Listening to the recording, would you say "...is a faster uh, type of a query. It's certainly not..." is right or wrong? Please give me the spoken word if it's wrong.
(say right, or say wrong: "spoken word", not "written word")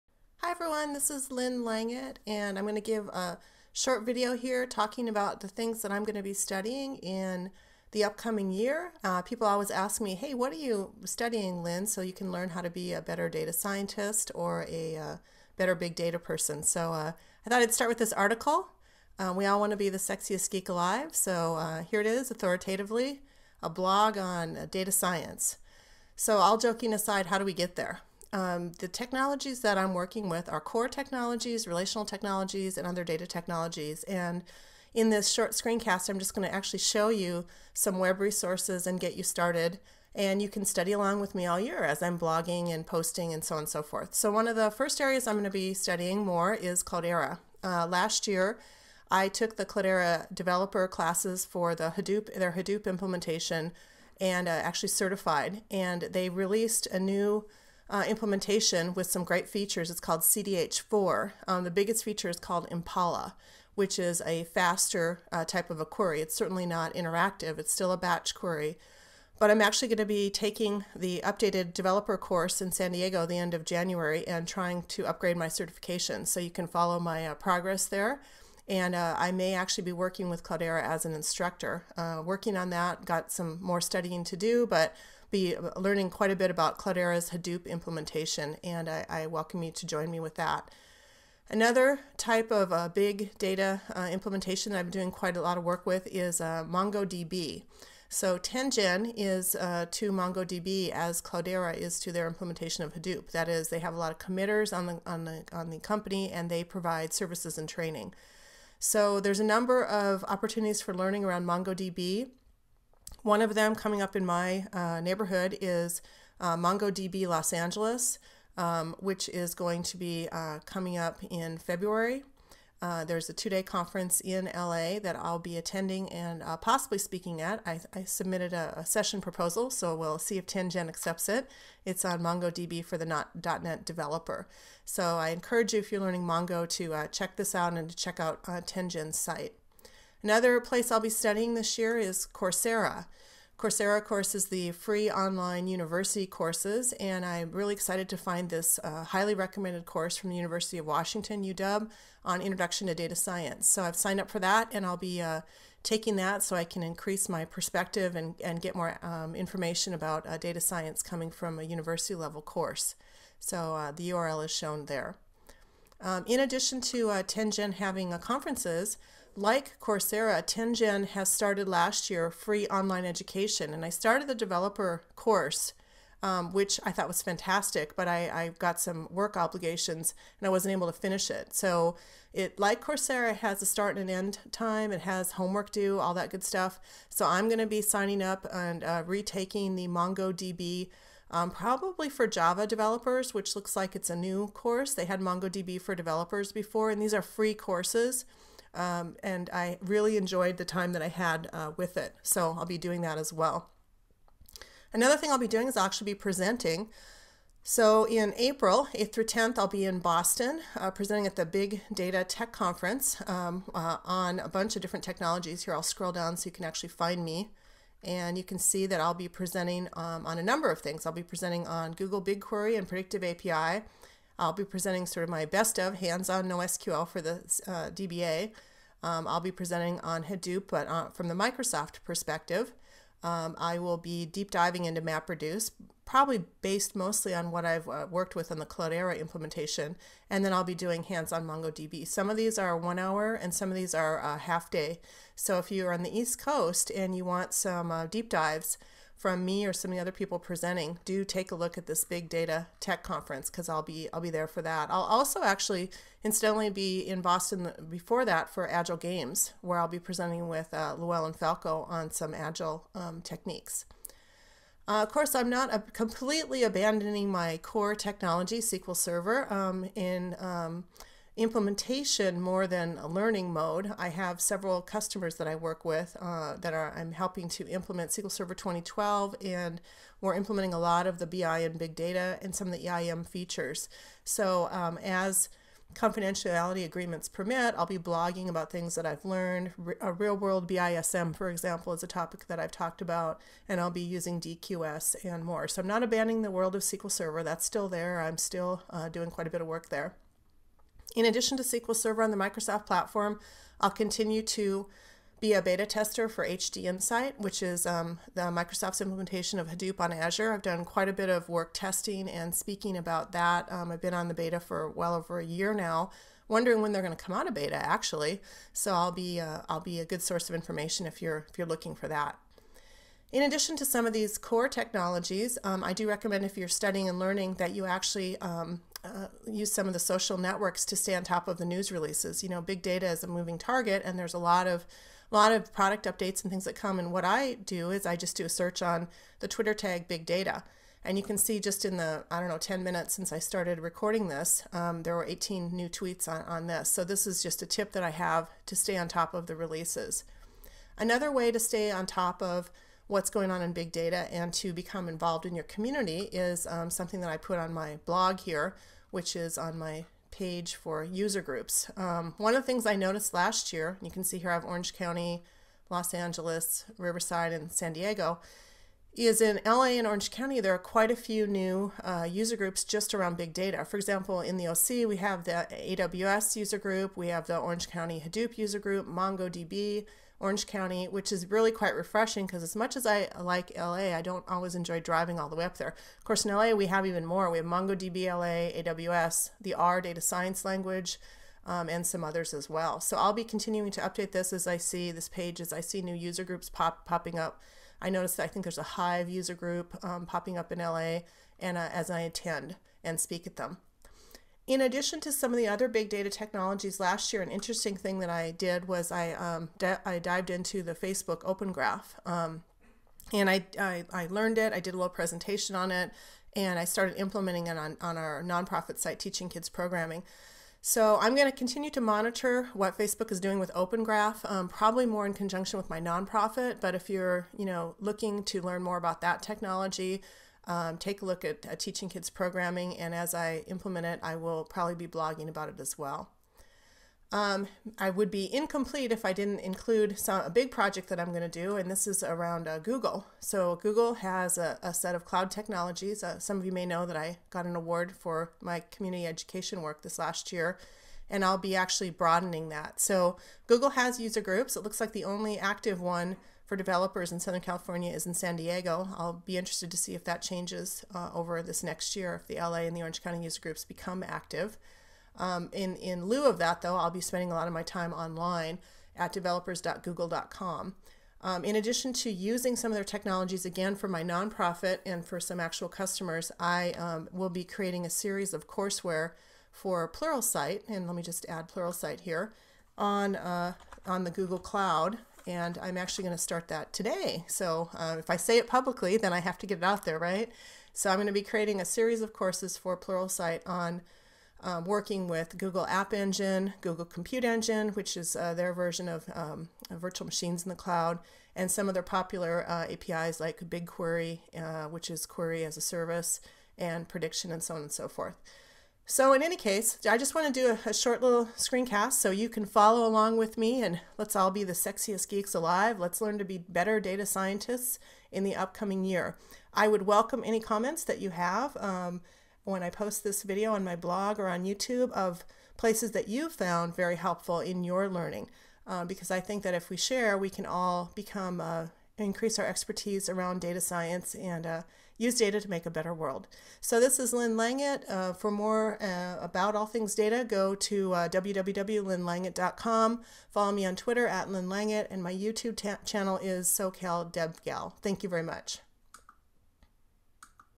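right.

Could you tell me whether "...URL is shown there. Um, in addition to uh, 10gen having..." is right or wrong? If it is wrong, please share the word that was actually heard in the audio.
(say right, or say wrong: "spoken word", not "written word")
right.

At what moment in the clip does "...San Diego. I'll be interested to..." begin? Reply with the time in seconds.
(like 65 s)
458 s.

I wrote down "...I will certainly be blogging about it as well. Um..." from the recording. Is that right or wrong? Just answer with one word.
wrong.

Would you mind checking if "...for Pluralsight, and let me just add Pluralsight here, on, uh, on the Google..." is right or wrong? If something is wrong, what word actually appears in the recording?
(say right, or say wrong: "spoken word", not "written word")
right.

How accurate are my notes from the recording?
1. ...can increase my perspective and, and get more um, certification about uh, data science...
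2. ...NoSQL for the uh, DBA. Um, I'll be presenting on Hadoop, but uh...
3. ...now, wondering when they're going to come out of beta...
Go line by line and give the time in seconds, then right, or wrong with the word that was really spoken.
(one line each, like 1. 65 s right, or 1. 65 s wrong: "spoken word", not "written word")
1. 156 s wrong: "information", not "certification"
2. 226 s right
3. 315 s right.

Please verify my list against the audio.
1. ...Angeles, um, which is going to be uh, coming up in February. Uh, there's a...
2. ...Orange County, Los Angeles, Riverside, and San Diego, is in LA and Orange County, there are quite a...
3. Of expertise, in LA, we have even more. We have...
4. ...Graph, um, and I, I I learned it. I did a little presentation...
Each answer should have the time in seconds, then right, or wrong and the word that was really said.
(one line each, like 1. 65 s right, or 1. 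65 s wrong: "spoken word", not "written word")
1. 117 s right
2. 364 s right
3. 386 s wrong: "course", not "expertise"
4. 411 s right.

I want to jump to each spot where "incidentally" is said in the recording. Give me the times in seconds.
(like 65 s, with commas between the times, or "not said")
256 s.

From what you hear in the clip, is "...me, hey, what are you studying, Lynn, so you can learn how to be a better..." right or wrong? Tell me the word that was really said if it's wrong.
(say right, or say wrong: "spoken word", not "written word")
right.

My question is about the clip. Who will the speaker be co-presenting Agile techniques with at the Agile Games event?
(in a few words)
Llewellyn Falco.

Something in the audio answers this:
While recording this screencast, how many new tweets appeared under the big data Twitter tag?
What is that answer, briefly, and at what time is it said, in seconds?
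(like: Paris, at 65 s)
18, at 345 s.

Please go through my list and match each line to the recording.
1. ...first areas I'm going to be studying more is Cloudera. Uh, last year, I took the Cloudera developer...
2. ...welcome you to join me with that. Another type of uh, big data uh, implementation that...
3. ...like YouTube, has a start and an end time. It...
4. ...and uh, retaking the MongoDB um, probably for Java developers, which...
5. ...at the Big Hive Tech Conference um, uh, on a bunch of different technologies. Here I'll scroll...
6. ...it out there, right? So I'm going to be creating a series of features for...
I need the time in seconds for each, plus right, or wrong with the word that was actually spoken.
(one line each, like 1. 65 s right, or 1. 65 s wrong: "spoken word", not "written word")
1. 44 s right
2. 89 s right
3. 182 s wrong: "Coursera", not "YouTube"
4. 188 s right
5. 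211 s wrong: "Data", not "Hive"
6. 489 s wrong: "courses", not "features".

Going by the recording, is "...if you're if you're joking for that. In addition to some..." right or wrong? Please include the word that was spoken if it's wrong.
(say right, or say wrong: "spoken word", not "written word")
wrong: "looking", not "joking".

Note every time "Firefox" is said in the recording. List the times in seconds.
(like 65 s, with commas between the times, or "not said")
not said.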